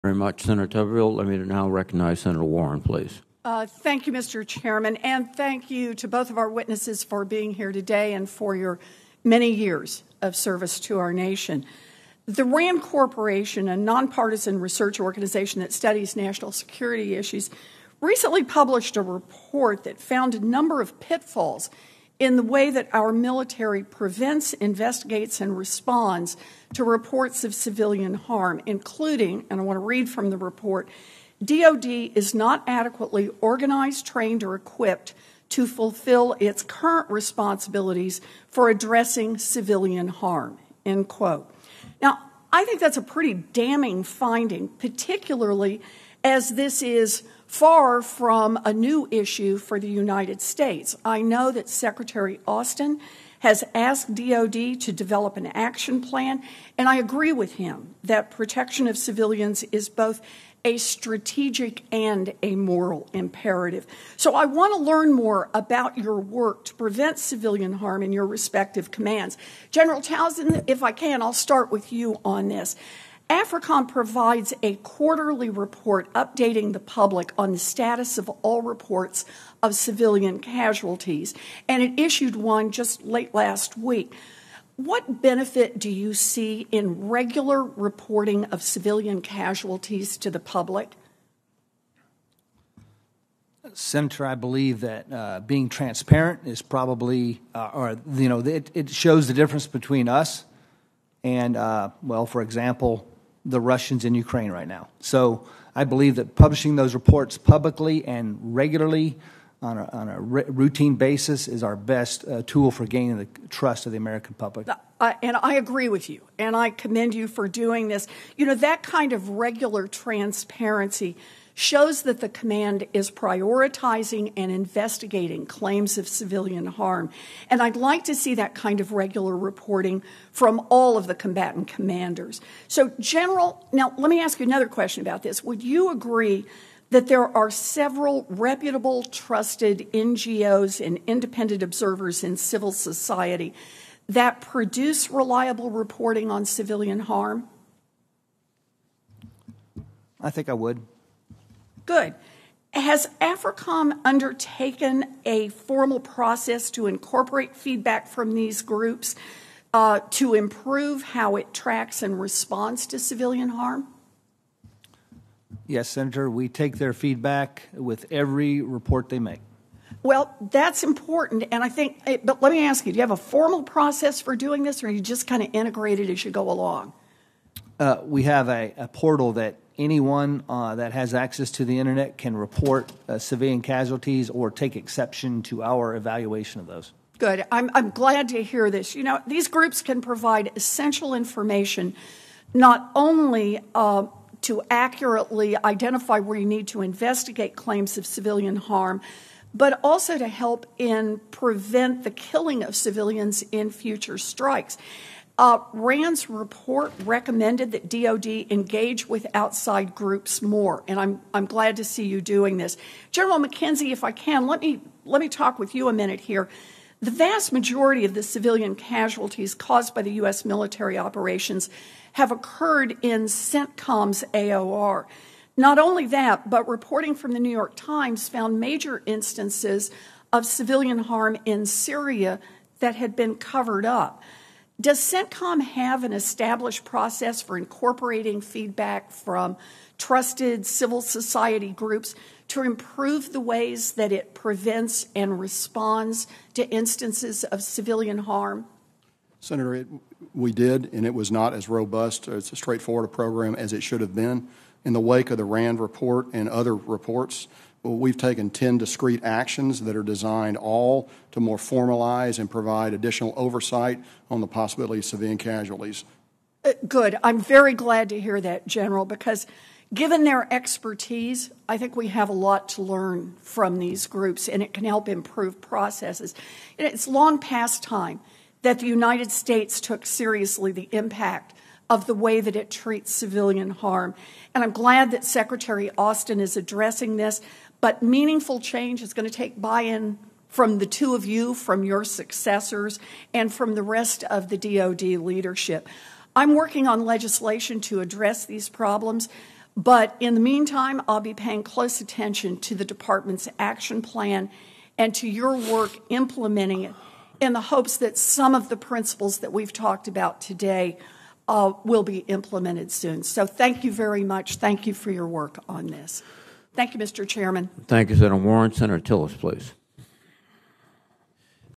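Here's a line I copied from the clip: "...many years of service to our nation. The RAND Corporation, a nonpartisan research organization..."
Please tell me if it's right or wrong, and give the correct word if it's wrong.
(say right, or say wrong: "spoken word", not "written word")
right.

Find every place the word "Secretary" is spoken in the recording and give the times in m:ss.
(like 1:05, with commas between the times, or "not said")
0:51, 4:45.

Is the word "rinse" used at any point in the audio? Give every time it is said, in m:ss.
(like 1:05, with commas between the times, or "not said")
not said.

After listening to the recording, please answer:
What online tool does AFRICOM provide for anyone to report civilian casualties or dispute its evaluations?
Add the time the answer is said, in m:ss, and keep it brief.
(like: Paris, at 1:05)
A portal, at 2:58.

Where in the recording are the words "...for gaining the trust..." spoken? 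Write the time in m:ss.
1:52.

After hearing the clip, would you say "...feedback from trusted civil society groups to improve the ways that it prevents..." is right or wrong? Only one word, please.
right.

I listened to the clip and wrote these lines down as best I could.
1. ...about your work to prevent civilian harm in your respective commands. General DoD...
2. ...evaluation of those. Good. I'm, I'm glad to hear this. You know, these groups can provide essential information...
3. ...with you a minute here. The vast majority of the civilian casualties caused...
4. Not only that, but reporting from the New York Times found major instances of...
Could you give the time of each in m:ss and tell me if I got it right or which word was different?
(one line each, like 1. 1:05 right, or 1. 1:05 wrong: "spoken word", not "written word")
1. 1:05 wrong: "Townsend", not "DoD"
2. 3:05 right
3. 3:35 right
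4. 3:45 right.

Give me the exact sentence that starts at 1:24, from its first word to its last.
What benefit do you see in regular reporting of civilian casualties to the public?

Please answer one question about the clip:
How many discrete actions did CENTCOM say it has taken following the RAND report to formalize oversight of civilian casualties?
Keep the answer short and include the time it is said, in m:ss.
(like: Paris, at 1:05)
10, at 4:18.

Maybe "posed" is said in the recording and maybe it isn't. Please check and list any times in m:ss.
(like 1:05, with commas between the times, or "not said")
not said.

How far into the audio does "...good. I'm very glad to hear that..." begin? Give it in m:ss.
4:26.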